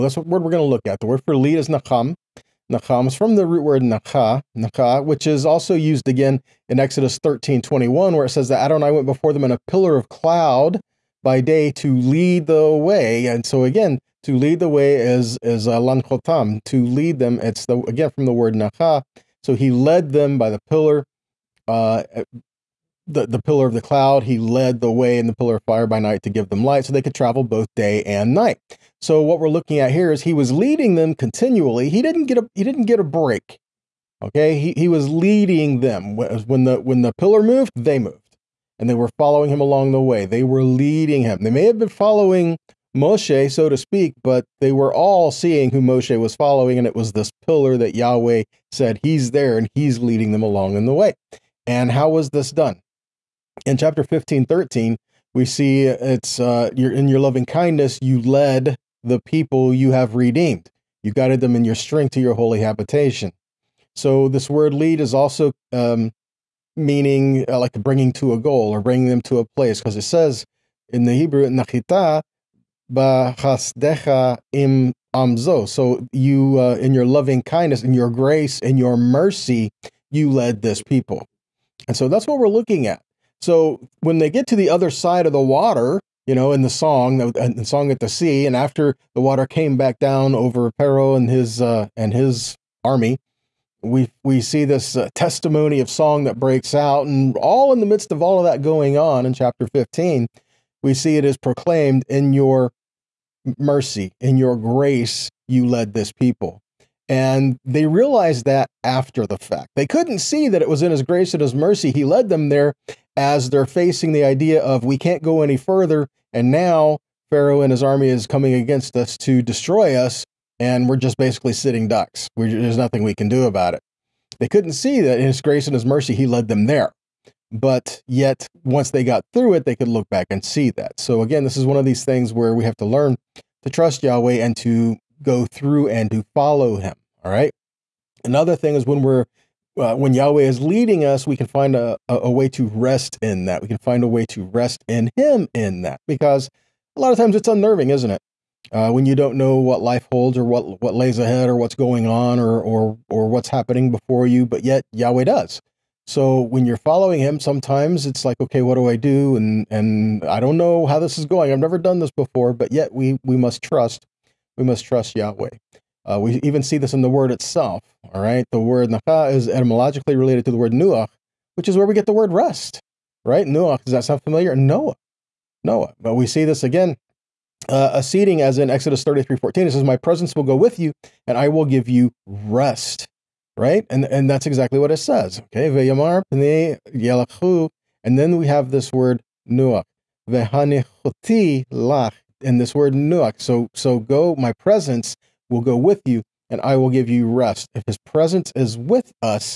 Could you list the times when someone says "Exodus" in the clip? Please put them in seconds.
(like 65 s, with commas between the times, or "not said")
6 s, 178 s.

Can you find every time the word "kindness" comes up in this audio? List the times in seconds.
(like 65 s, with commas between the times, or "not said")
57 s, 77 s.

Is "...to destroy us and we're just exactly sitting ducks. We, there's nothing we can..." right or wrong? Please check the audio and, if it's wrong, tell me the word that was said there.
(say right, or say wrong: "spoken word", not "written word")
wrong: "basically", not "exactly".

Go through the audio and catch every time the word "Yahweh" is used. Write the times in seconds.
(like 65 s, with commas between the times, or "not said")
47 s, 134 s, 140 s, 154 s, 165 s.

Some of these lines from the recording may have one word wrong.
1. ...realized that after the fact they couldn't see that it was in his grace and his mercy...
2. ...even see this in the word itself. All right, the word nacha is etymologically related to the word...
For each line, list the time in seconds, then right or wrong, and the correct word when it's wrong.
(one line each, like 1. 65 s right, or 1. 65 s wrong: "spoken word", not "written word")
1. 107 s right
2. 166 s right.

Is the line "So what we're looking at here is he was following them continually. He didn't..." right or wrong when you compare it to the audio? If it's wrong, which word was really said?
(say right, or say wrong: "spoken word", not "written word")
wrong: "leading", not "following".